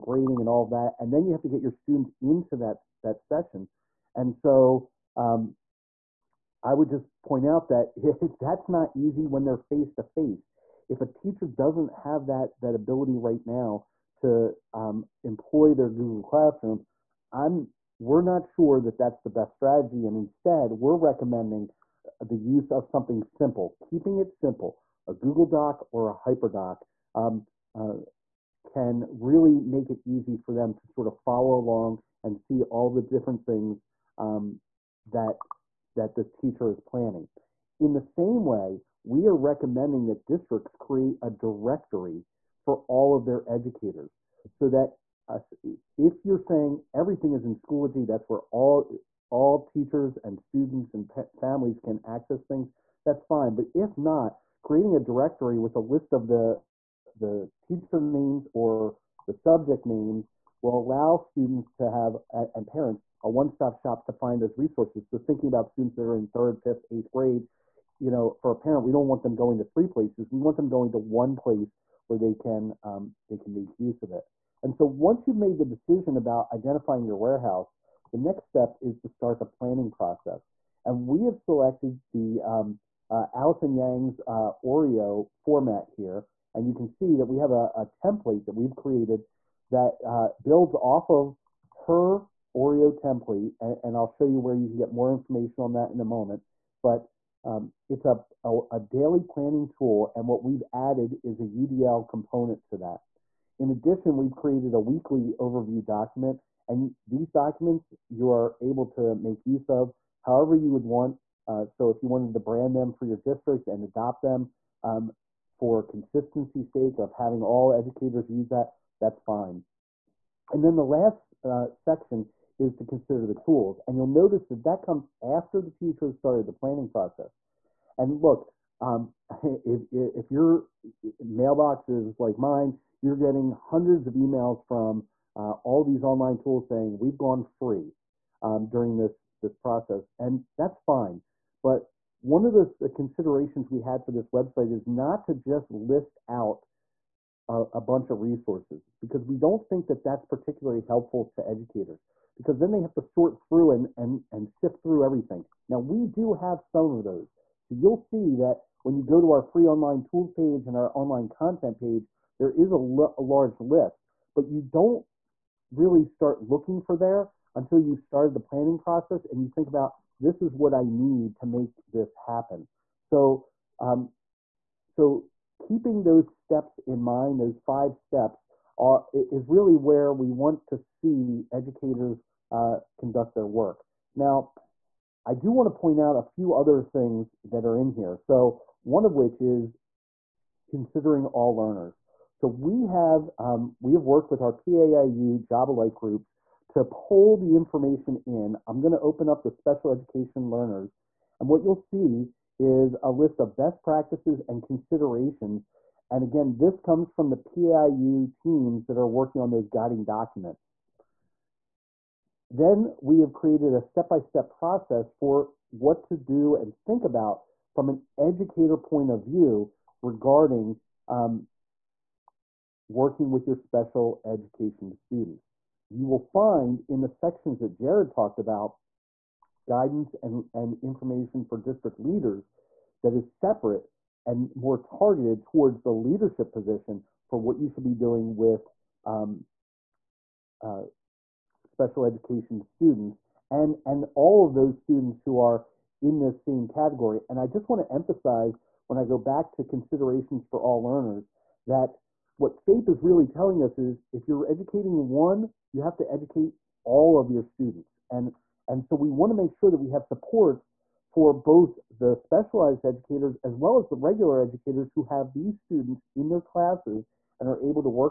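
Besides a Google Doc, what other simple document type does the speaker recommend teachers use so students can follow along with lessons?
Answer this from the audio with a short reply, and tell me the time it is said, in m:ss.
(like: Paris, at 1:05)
HyperDoc, at 0:26.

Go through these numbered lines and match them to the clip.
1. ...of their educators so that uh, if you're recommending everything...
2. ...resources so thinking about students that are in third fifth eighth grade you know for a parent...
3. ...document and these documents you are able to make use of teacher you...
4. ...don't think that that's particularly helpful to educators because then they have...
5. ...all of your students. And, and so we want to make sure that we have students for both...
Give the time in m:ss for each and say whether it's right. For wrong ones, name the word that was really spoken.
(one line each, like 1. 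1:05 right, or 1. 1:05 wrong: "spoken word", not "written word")
1. 0:43 wrong: "saying", not "recommending"
2. 1:04 right
3. 1:45 wrong: "however", not "teacher"
4. 2:29 right
5. 4:16 wrong: "supports", not "students".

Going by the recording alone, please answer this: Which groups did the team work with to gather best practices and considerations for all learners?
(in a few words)
PAIU job alike groups.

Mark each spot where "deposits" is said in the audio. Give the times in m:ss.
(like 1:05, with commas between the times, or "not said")
not said.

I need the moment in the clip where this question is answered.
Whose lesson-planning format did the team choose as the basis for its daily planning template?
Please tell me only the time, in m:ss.
1:23.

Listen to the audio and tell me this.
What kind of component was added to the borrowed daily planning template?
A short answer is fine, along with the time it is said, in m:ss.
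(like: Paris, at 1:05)
UDL, at 1:41.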